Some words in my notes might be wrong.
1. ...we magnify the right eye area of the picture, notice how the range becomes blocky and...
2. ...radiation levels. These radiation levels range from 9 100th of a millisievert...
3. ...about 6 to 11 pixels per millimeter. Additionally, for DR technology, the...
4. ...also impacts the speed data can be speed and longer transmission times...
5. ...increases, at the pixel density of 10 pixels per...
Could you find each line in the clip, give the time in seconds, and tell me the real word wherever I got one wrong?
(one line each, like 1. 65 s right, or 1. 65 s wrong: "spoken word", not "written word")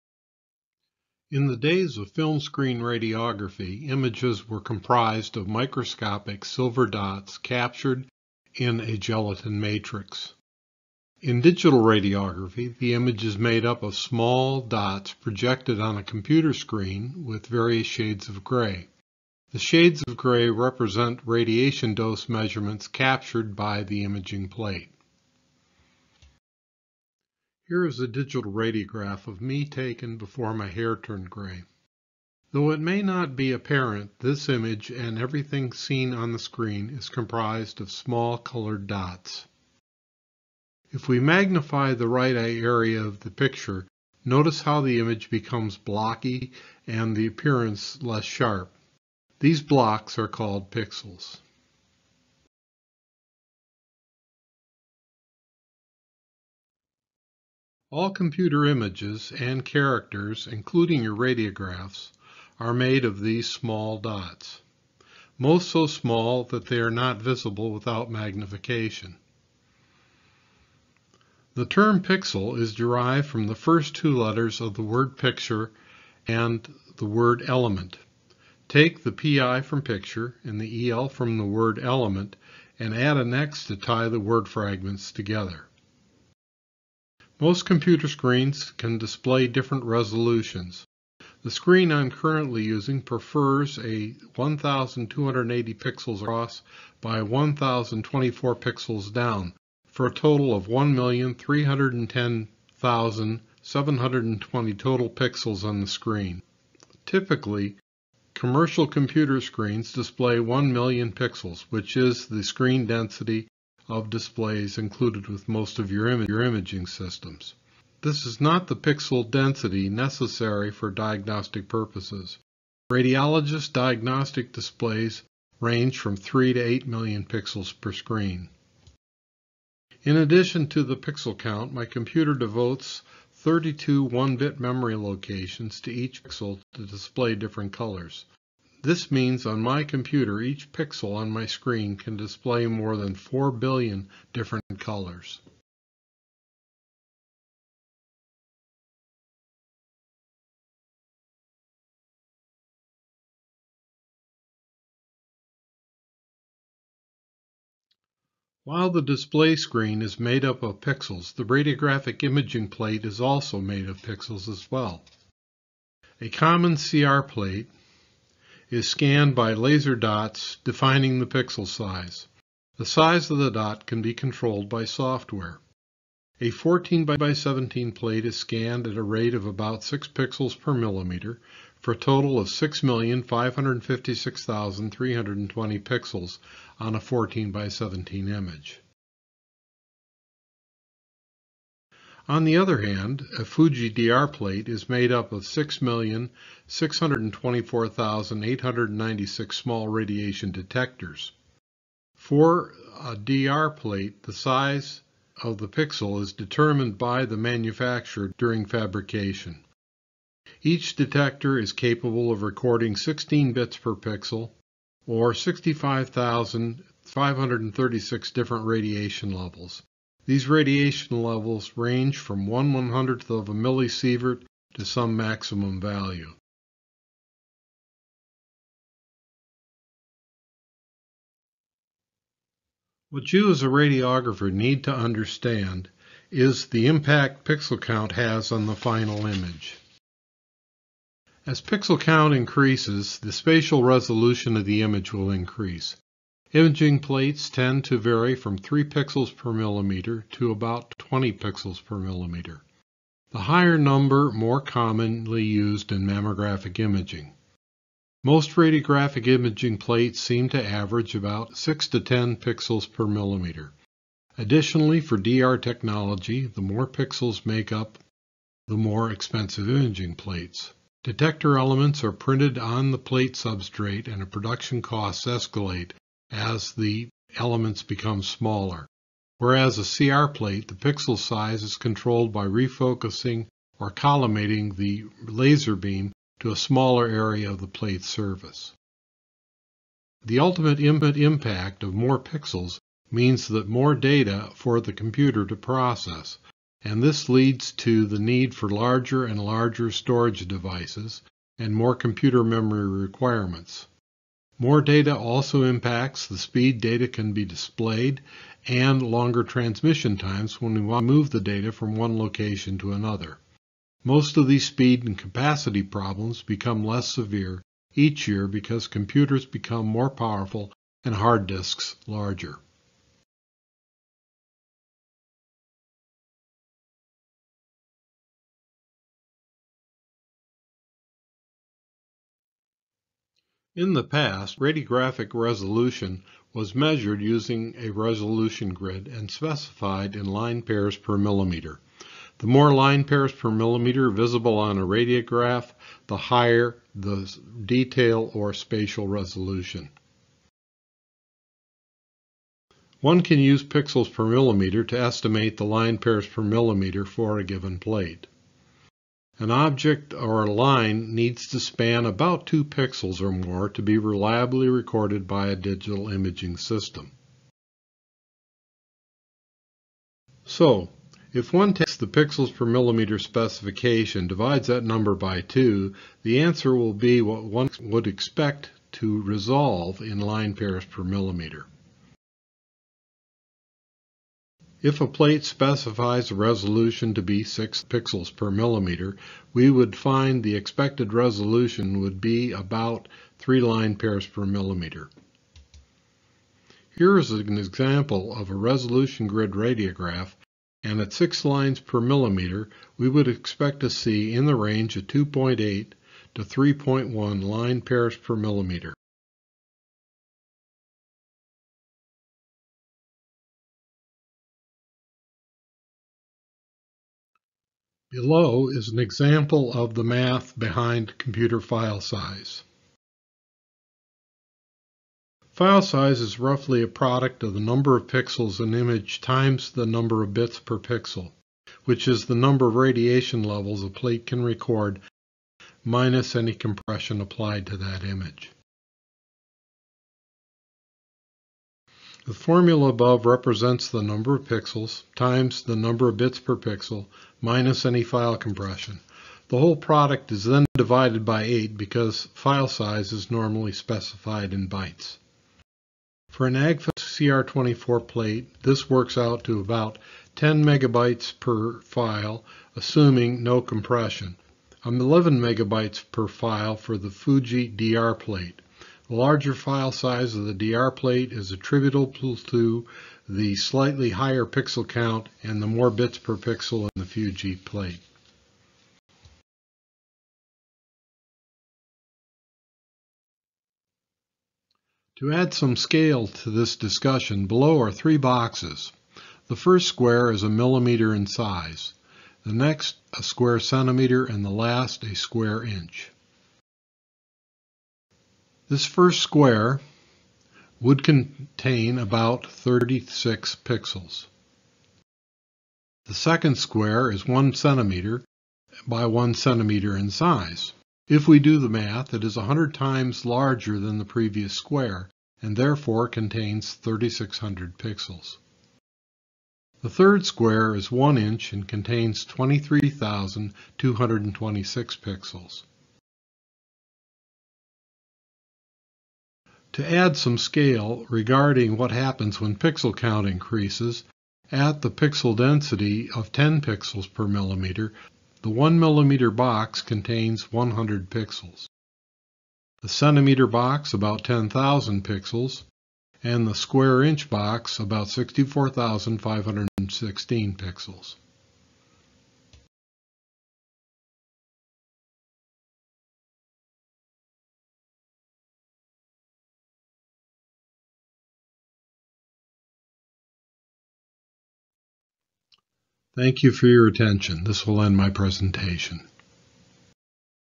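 1. 41 s wrong: "image", not "range"
2. 218 s wrong: "1", not "9"
3. 261 s wrong: "10", not "11"
4. 305 s wrong: "displayed", not "speed"
5. 533 s right.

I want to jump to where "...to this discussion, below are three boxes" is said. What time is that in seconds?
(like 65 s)
486 s.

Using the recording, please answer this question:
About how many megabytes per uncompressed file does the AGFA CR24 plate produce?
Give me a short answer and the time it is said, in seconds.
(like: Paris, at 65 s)
10 megabytes, at 460 s.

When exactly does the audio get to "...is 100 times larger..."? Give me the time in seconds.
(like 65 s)
512 s.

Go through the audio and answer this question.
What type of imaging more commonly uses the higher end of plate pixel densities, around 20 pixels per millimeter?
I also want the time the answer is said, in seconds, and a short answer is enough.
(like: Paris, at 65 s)
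mammographic imaging, at 256 s.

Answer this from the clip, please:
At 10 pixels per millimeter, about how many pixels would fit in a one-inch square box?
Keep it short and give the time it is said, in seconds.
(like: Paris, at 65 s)
64,516, at 548 s.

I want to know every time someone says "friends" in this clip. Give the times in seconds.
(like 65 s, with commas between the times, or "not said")
not said.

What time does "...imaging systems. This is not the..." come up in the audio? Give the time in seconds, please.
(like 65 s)
116 s.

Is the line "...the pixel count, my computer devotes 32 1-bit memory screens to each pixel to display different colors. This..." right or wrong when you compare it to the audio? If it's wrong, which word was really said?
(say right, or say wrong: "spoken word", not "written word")
wrong: "locations", not "screens".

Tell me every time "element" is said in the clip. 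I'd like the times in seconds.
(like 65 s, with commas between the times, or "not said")
77 s, 81 s, 271 s, 277 s.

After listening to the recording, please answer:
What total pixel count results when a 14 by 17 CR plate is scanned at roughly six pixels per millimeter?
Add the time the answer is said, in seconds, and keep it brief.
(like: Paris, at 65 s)
6,556,320, at 182 s.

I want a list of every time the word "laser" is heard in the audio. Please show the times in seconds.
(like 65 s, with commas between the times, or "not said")
169 s, 285 s.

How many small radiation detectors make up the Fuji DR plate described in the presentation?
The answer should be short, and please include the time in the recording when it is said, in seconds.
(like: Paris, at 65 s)
6,624,896, at 195 s.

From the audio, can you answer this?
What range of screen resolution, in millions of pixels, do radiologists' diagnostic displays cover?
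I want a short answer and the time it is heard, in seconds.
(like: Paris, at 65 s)
3 to 8 million, at 126 s.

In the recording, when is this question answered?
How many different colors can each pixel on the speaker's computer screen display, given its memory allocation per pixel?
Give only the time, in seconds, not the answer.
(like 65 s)
142 s.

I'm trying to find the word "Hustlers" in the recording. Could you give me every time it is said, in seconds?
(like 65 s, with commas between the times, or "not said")
not said.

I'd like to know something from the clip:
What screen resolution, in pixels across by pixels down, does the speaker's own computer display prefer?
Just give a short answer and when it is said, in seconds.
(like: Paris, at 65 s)
1280 by 1024, at 94 s.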